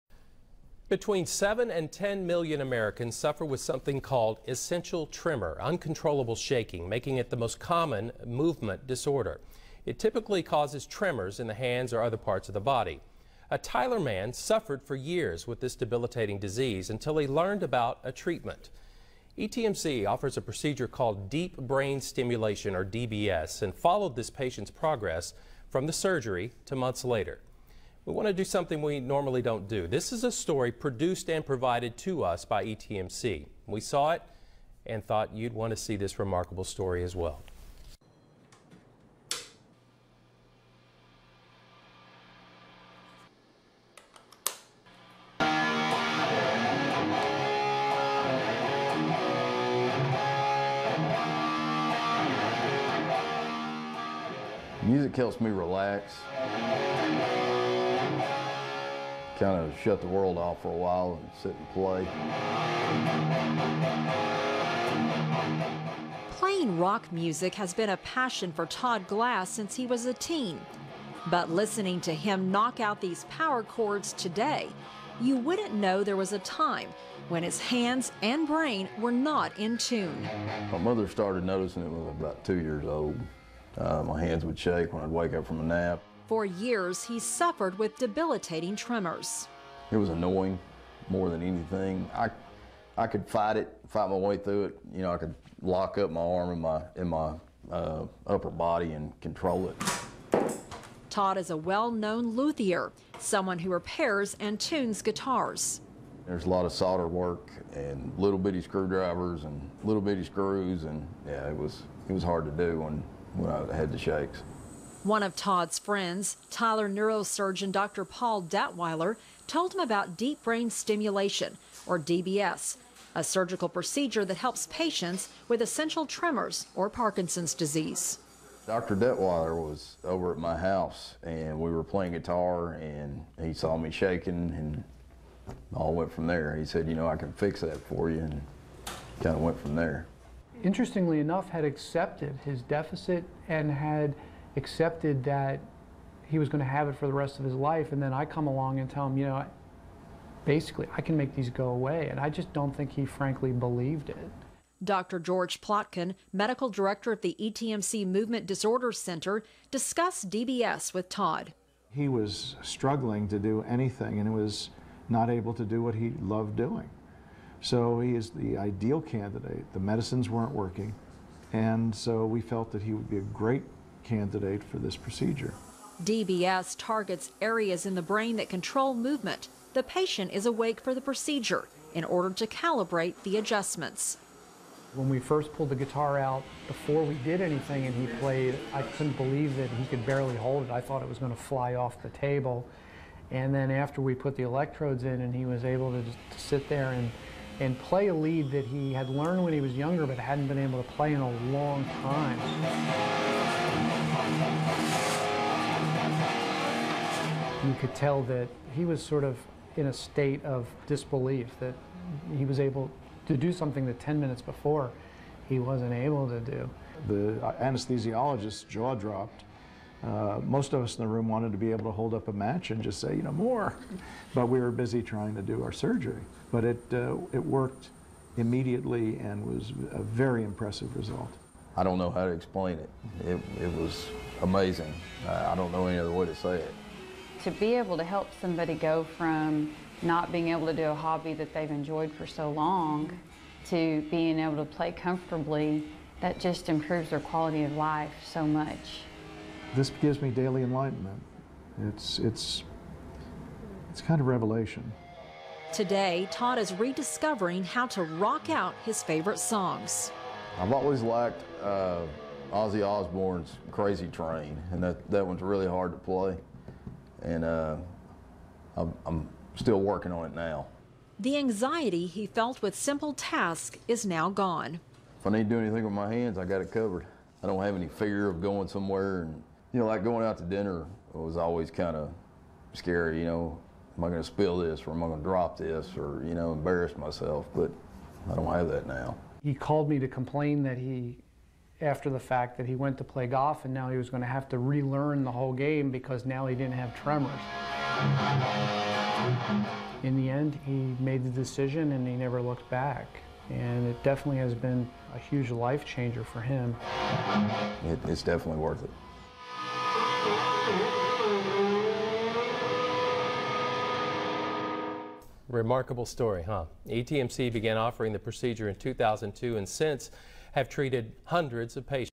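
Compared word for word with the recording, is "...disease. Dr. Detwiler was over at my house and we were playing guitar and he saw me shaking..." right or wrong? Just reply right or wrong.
right.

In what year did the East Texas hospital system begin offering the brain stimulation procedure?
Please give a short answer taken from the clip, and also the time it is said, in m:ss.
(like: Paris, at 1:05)
2002, at 5:18.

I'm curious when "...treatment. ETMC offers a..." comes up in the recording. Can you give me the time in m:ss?
0:18.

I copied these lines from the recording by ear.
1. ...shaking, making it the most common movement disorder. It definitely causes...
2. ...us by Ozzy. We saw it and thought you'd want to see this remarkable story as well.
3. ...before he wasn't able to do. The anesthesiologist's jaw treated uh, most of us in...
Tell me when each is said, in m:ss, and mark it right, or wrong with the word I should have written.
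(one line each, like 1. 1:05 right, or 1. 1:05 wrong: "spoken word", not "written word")
1. 0:06 wrong: "typically", not "definitely"
2. 0:32 wrong: "ETMC", not "Ozzy"
3. 3:34 wrong: "dropped", not "treated".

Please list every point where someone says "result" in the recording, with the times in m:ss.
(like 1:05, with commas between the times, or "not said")
3:50.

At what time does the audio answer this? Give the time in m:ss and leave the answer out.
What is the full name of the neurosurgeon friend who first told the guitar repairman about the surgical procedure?
1:58.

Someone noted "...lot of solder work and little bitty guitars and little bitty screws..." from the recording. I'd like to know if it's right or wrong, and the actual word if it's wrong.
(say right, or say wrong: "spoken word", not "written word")
wrong: "screwdrivers", not "guitars".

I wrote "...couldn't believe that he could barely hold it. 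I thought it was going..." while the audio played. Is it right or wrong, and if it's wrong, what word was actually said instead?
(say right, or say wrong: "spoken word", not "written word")
right.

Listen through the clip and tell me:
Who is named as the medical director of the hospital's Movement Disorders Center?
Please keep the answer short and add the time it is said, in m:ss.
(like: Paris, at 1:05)
George Plotkin, at 2:35.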